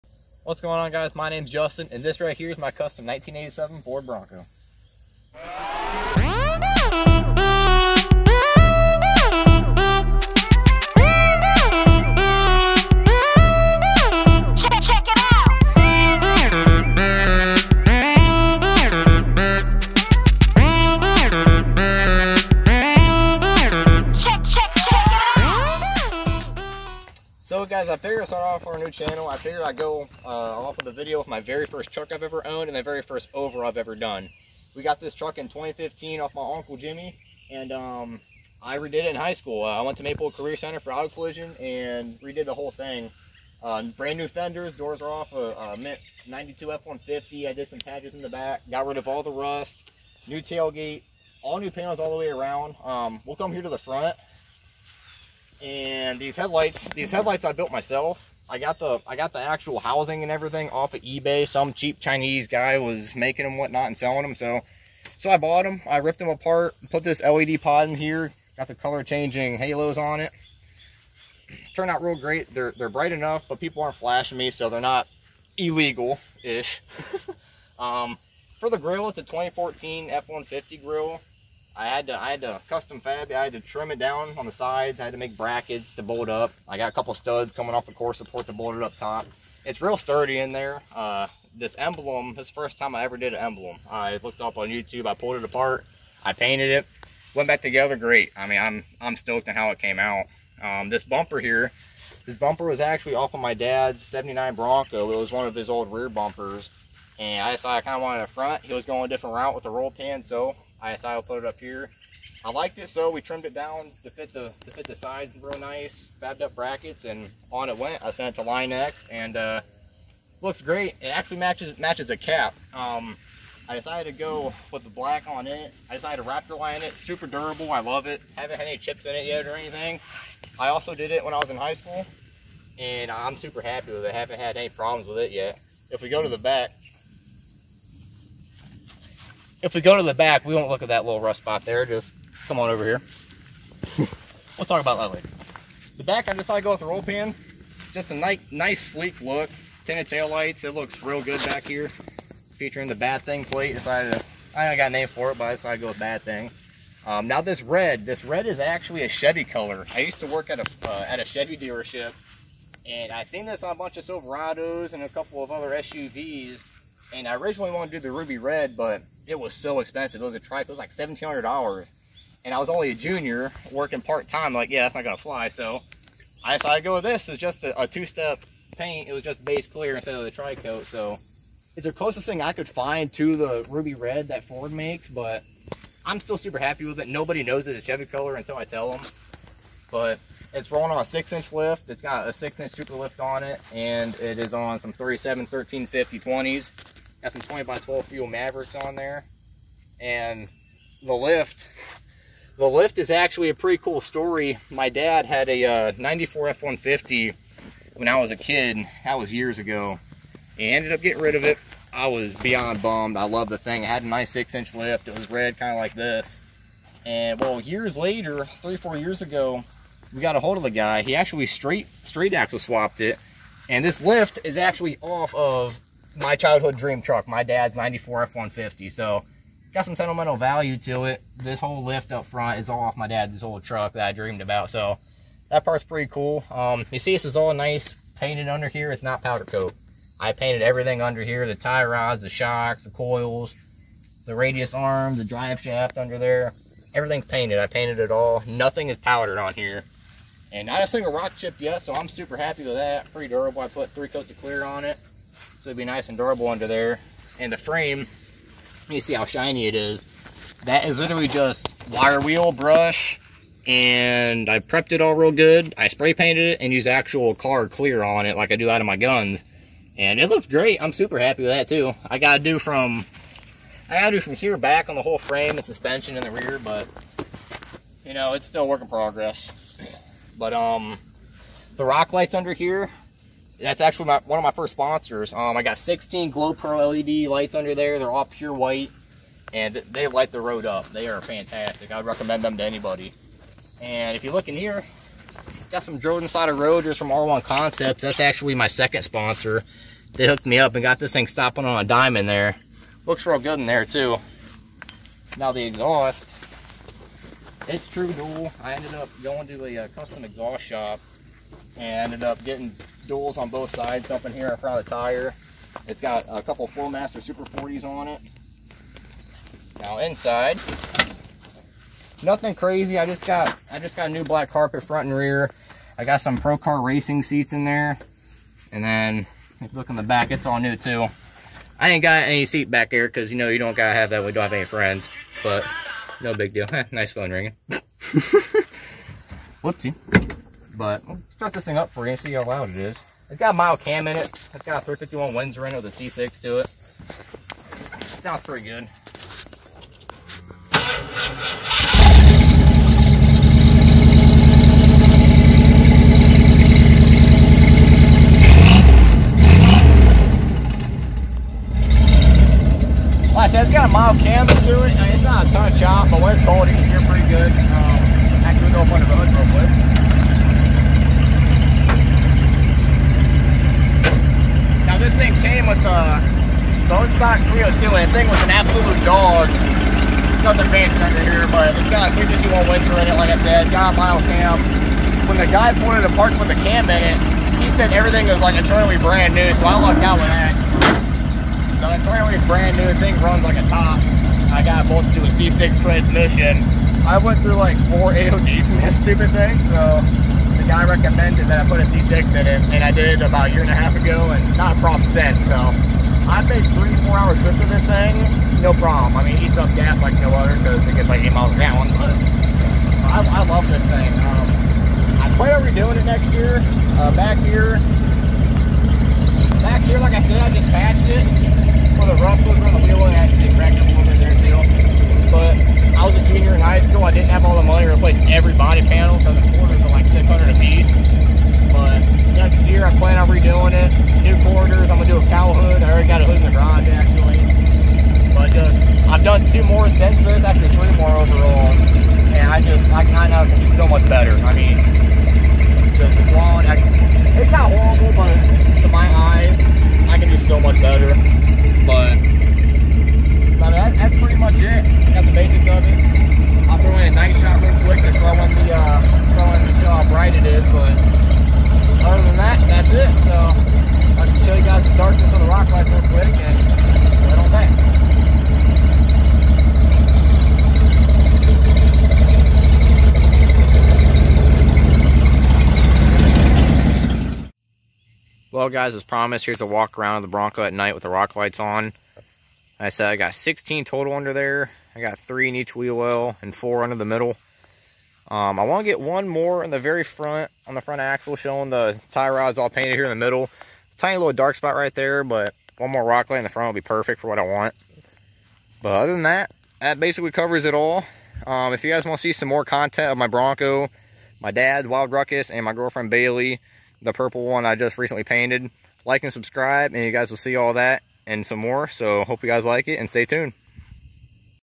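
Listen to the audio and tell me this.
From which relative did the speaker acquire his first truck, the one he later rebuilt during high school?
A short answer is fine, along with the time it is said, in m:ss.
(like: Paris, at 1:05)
Uncle Jimmy, at 0:36.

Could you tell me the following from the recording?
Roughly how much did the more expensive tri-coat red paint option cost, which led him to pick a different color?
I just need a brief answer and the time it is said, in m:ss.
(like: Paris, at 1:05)
$1,700, at 2:50.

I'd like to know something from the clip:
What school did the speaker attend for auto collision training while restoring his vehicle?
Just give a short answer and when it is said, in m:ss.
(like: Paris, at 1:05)
Maple Career Center, at 0:40.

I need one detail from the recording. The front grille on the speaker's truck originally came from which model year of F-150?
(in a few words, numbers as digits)
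2014.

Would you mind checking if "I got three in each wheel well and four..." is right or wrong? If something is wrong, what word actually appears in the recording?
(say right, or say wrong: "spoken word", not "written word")
right.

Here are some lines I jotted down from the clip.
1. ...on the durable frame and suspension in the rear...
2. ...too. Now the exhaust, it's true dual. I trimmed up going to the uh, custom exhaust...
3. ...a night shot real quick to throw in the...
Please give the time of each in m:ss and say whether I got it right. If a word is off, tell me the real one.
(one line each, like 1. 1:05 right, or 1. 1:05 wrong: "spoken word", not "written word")
1. 4:34 wrong: "whole", not "durable"
2. 5:03 wrong: "ended", not "trimmed"
3. 7:37 right.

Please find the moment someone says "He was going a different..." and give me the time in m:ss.
1:48.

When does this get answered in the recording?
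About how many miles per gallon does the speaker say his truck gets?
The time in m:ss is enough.
6:51.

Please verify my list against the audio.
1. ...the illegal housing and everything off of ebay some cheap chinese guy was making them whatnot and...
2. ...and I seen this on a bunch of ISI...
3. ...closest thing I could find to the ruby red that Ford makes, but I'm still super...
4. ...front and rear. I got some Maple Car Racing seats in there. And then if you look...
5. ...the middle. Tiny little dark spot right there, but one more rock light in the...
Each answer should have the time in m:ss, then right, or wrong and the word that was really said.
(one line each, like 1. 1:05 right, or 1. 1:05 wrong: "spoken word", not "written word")
1. 0:59 wrong: "actual", not "illegal"
2. 2:42 wrong: "Silverados", not "ISI"
3. 3:01 right
4. 5:24 wrong: "Pro", not "Maple"
5. 8:13 right.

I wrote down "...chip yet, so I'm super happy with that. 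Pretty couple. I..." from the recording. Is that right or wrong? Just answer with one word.
wrong.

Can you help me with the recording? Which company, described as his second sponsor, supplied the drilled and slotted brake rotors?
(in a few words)
R1 Concepts.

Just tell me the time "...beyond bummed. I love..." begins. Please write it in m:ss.
3:32.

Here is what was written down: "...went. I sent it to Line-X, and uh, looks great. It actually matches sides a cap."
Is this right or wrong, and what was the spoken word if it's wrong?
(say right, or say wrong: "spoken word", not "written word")
wrong: "matches", not "sides".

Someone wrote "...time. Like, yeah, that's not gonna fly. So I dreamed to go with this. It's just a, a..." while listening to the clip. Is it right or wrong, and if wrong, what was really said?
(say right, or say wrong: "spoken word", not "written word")
wrong: "decided", not "dreamed".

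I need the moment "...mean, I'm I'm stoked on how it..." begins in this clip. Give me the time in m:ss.
1:38.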